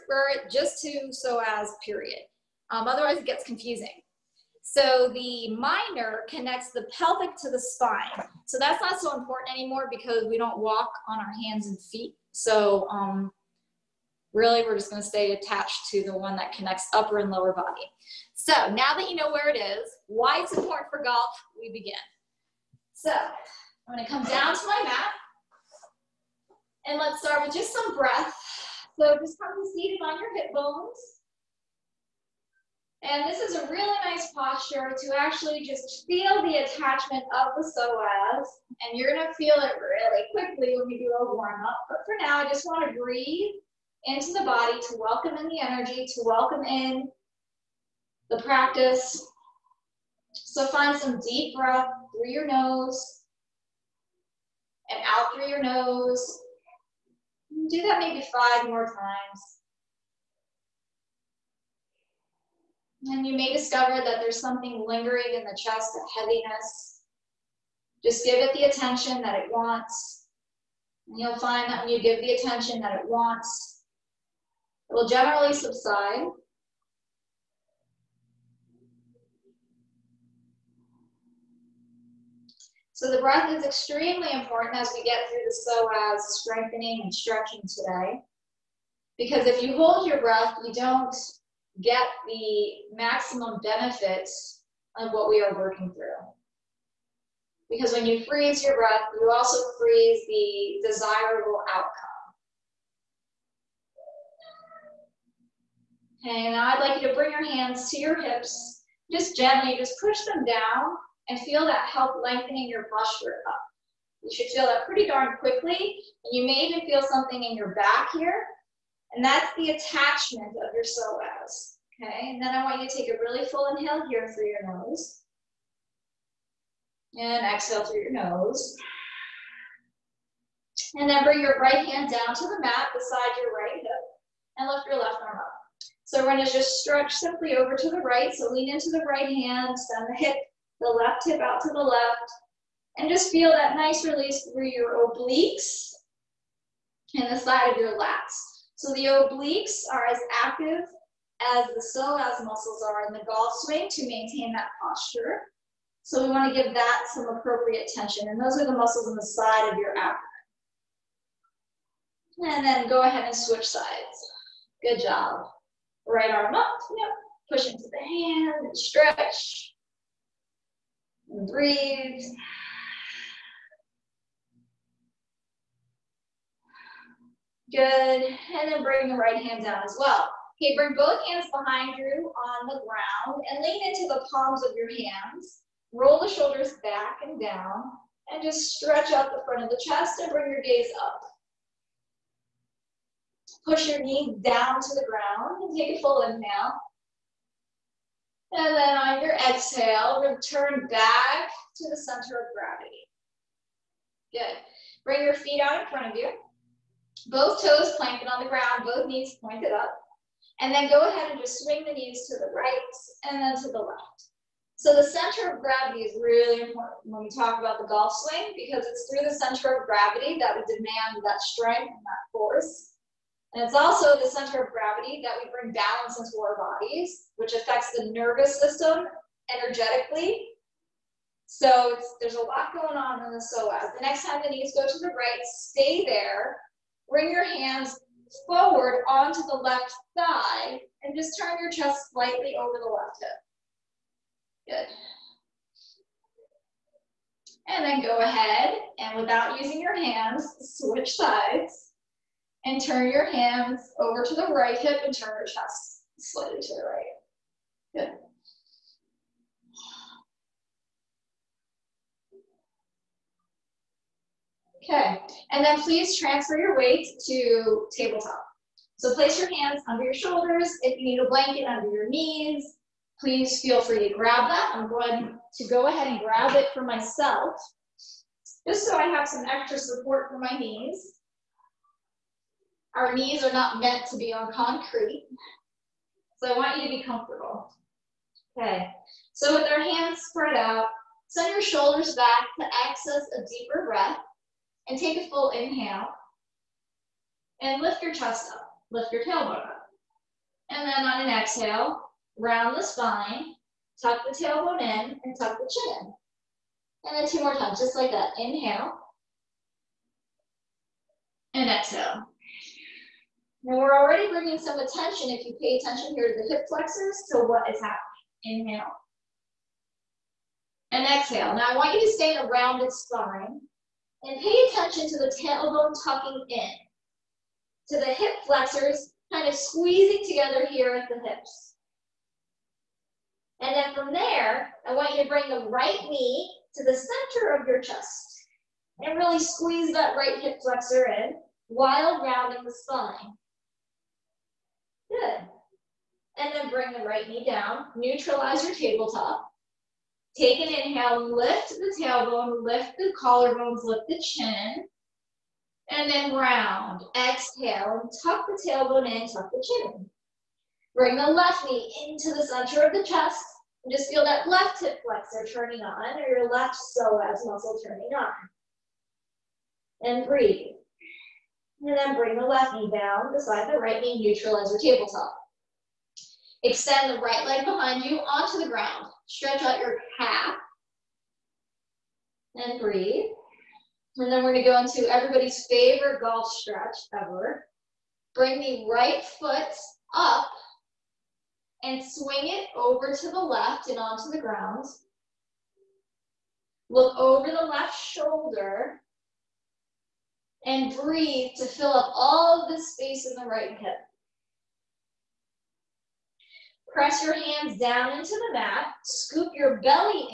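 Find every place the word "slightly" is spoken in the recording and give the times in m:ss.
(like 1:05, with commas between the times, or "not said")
4:02, 4:16.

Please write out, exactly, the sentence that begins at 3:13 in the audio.
Push your knee down to the ground and take a full inhale.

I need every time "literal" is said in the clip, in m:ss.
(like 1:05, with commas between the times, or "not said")
not said.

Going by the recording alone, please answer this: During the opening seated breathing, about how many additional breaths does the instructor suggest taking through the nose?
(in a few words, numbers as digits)
5.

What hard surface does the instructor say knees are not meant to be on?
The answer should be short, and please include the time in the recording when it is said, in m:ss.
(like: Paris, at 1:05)
Concrete, at 4:44.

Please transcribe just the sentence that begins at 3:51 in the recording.
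So there's a lot going on in the psoas.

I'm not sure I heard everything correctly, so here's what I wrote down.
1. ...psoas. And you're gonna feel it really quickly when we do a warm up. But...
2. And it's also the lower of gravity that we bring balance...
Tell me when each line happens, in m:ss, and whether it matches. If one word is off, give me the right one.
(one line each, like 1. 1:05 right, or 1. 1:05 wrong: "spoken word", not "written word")
1. 0:37 right
2. 3:43 wrong: "center", not "lower".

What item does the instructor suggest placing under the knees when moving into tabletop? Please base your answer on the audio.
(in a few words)
A blanket.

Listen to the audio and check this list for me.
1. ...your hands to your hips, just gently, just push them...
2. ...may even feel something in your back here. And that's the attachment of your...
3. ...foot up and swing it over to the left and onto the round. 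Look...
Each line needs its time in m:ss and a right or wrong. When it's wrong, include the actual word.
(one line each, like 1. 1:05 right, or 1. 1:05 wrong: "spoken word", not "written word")
1. 1:47 right
2. 1:56 right
3. 6:29 wrong: "ground", not "round".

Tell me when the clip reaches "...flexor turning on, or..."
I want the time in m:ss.
6:05.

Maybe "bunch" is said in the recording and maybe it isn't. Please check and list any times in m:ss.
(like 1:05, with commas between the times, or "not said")
not said.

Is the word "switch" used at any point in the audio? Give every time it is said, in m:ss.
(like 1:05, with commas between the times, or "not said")
2:43, 4:10.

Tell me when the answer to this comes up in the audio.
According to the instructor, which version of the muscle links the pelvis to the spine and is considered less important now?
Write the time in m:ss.
0:05.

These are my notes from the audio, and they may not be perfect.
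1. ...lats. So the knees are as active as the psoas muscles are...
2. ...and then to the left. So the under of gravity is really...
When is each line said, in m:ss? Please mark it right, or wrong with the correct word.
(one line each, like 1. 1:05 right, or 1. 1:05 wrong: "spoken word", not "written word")
1. 2:27 wrong: "obliques", not "knees"
2. 3:33 wrong: "center", not "under".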